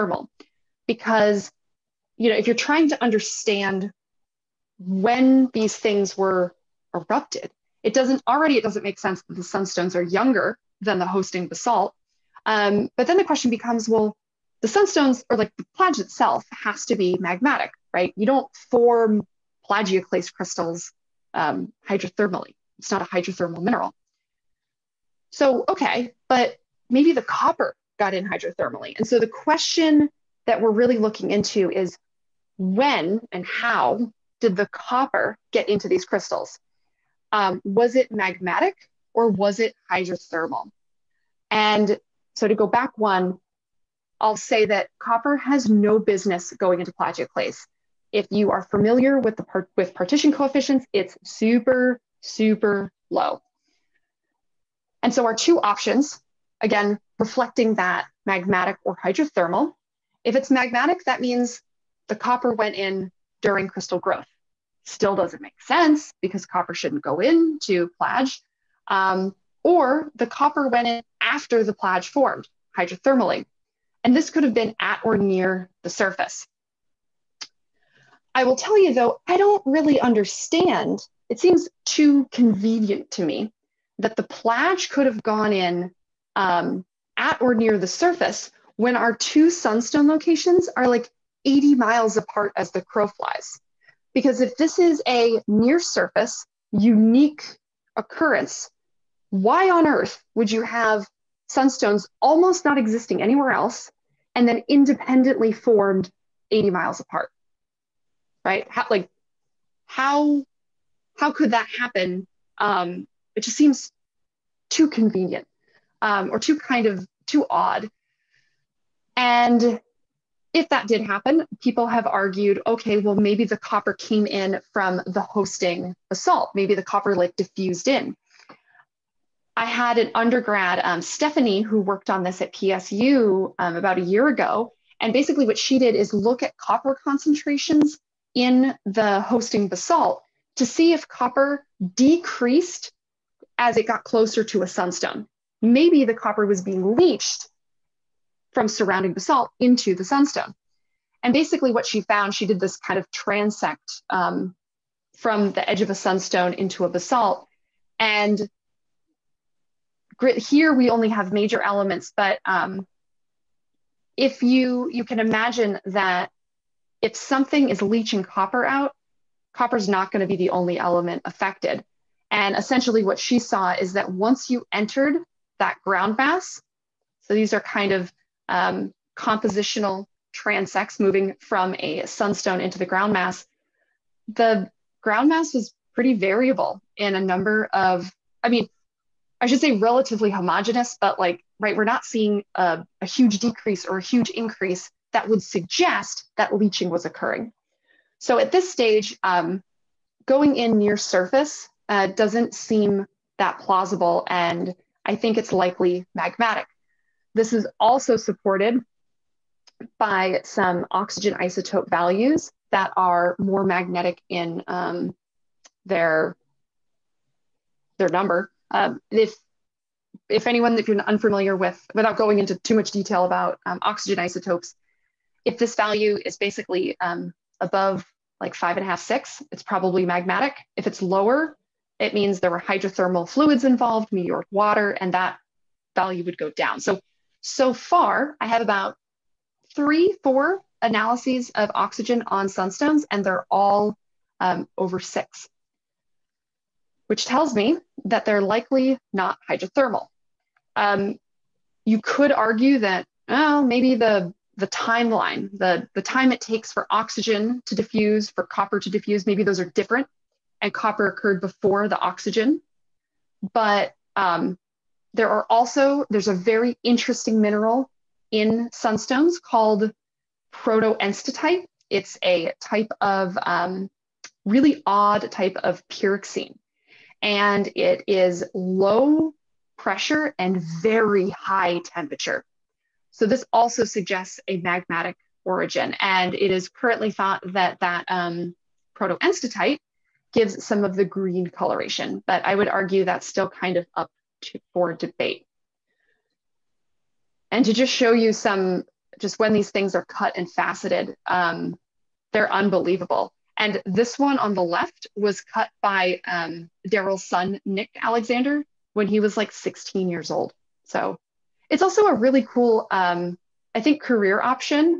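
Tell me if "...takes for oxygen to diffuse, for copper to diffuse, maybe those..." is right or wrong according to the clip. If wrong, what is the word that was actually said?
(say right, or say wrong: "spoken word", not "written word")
right.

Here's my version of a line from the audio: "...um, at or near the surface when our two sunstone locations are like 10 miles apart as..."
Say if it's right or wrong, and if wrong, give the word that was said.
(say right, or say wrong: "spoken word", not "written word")
wrong: "80", not "10".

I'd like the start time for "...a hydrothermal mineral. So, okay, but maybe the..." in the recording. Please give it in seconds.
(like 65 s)
23 s.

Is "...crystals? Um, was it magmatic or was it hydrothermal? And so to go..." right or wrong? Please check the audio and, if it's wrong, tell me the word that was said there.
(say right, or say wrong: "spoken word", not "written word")
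right.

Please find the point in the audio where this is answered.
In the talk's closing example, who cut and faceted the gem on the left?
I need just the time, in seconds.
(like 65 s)
307 s.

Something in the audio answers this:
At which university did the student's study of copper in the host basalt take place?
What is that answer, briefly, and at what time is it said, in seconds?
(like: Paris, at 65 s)
PSU, at 132 s.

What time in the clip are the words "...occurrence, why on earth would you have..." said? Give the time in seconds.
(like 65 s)
97 s.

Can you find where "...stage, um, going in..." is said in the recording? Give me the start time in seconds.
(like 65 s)
198 s.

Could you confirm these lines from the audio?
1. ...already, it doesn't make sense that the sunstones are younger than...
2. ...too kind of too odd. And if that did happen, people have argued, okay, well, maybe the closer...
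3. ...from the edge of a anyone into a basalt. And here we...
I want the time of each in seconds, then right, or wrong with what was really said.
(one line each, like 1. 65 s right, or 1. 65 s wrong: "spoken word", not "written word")
1. 8 s right
2. 116 s wrong: "copper", not "closer"
3. 155 s wrong: "sunstone", not "anyone".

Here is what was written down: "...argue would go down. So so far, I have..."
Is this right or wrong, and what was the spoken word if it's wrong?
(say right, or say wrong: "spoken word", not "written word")
wrong: "value", not "argue".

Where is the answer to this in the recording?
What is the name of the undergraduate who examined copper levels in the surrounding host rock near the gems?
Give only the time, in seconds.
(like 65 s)
131 s.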